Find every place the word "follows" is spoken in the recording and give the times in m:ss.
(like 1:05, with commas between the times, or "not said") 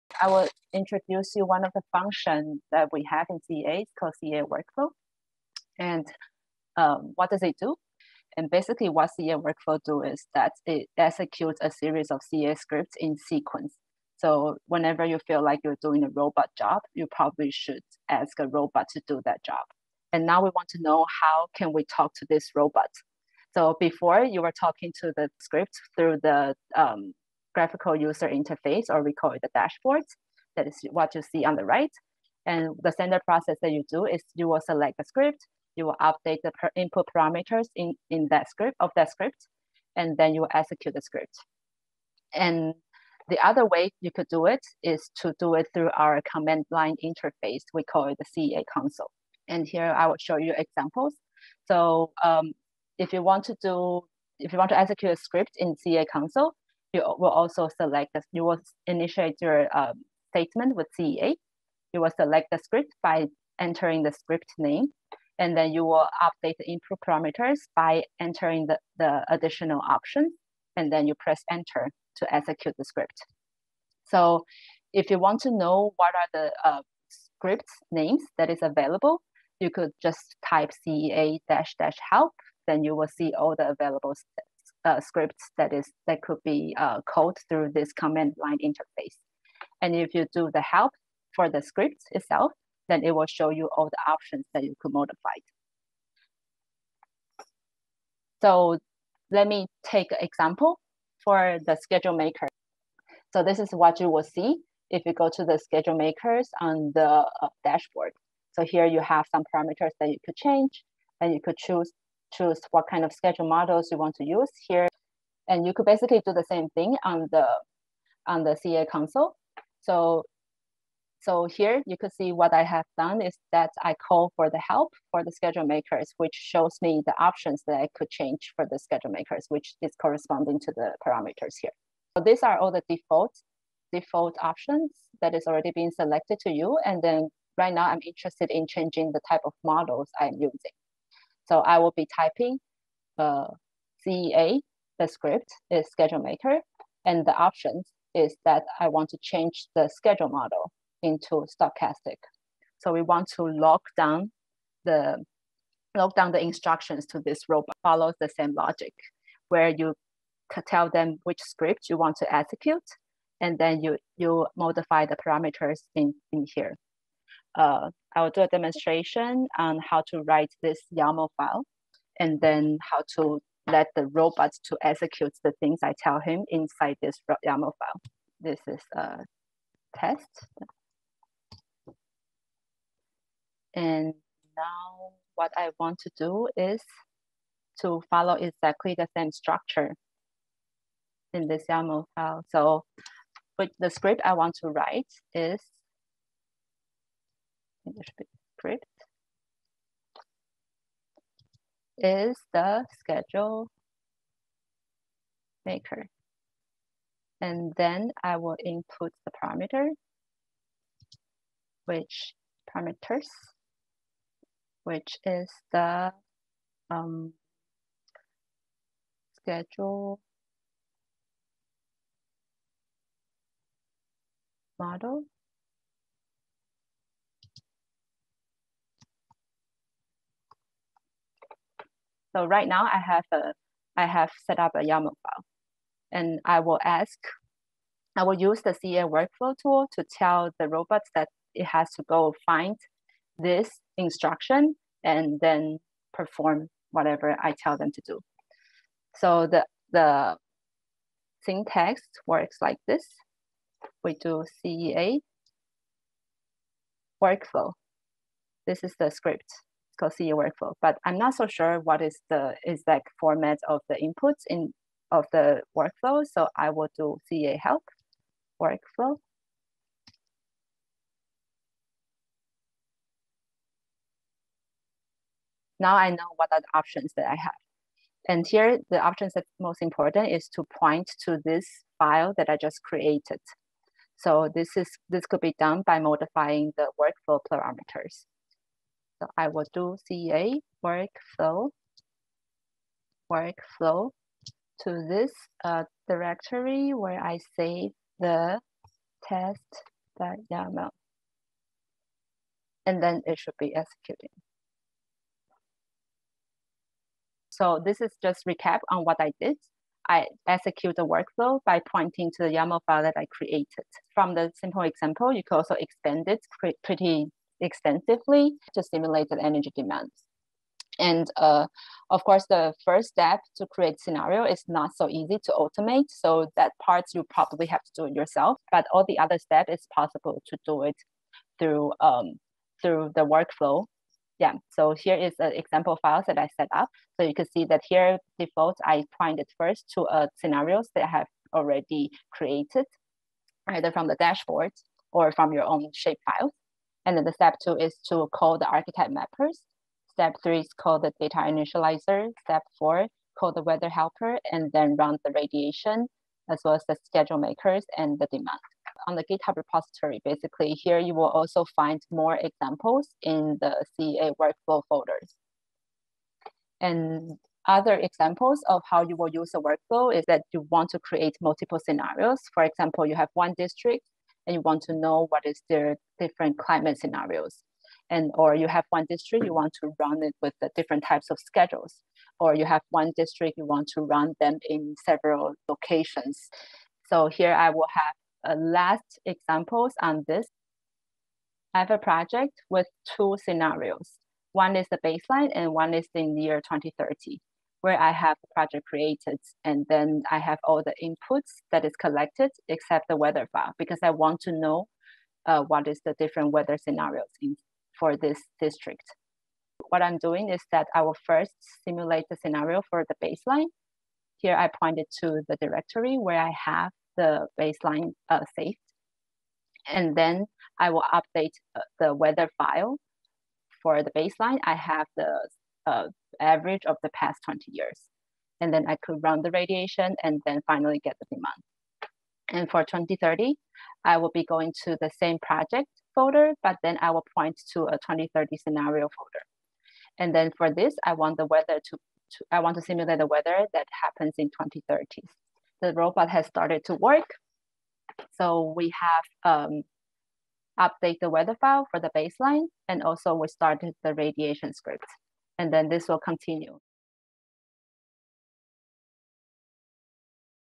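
2:37, 3:08.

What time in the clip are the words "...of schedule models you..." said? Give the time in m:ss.
1:53.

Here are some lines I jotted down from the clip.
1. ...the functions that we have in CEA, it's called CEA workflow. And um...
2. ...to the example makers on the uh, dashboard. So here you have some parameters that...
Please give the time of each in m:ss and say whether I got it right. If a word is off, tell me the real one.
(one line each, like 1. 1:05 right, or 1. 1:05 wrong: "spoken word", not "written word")
1. 0:01 right
2. 1:45 wrong: "schedule", not "example".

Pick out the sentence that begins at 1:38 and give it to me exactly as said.
So let me take an example for the schedule maker.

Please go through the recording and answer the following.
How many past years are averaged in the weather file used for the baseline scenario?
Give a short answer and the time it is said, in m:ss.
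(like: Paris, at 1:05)
20, at 7:07.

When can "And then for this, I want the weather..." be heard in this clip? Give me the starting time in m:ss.
7:20.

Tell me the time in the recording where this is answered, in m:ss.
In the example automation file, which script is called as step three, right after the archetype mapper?
5:51.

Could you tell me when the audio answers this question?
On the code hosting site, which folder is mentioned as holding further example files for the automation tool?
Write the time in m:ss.
6:03.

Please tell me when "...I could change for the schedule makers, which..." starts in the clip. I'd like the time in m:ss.
2:07.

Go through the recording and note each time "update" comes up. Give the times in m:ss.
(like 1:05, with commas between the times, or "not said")
0:36, 1:06, 7:01, 7:30.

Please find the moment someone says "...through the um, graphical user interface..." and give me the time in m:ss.
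0:25.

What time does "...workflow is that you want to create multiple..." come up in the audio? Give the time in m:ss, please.
6:09.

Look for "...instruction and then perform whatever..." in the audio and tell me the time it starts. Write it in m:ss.
4:03.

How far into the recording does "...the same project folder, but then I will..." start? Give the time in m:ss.
7:14.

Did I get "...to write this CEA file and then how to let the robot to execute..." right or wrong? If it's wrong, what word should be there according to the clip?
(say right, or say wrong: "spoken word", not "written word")
wrong: "YAML", not "CEA".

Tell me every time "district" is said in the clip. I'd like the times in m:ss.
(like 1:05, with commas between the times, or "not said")
6:13, 6:19, 6:23, 6:48.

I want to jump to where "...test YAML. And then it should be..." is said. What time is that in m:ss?
4:59.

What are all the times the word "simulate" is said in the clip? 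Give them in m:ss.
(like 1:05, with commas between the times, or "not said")
5:18, 6:51, 7:22.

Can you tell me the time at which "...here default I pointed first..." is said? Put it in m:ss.
5:37.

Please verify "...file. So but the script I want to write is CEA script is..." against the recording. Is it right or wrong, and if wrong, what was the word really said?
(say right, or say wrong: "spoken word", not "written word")
wrong: "English", not "CEA".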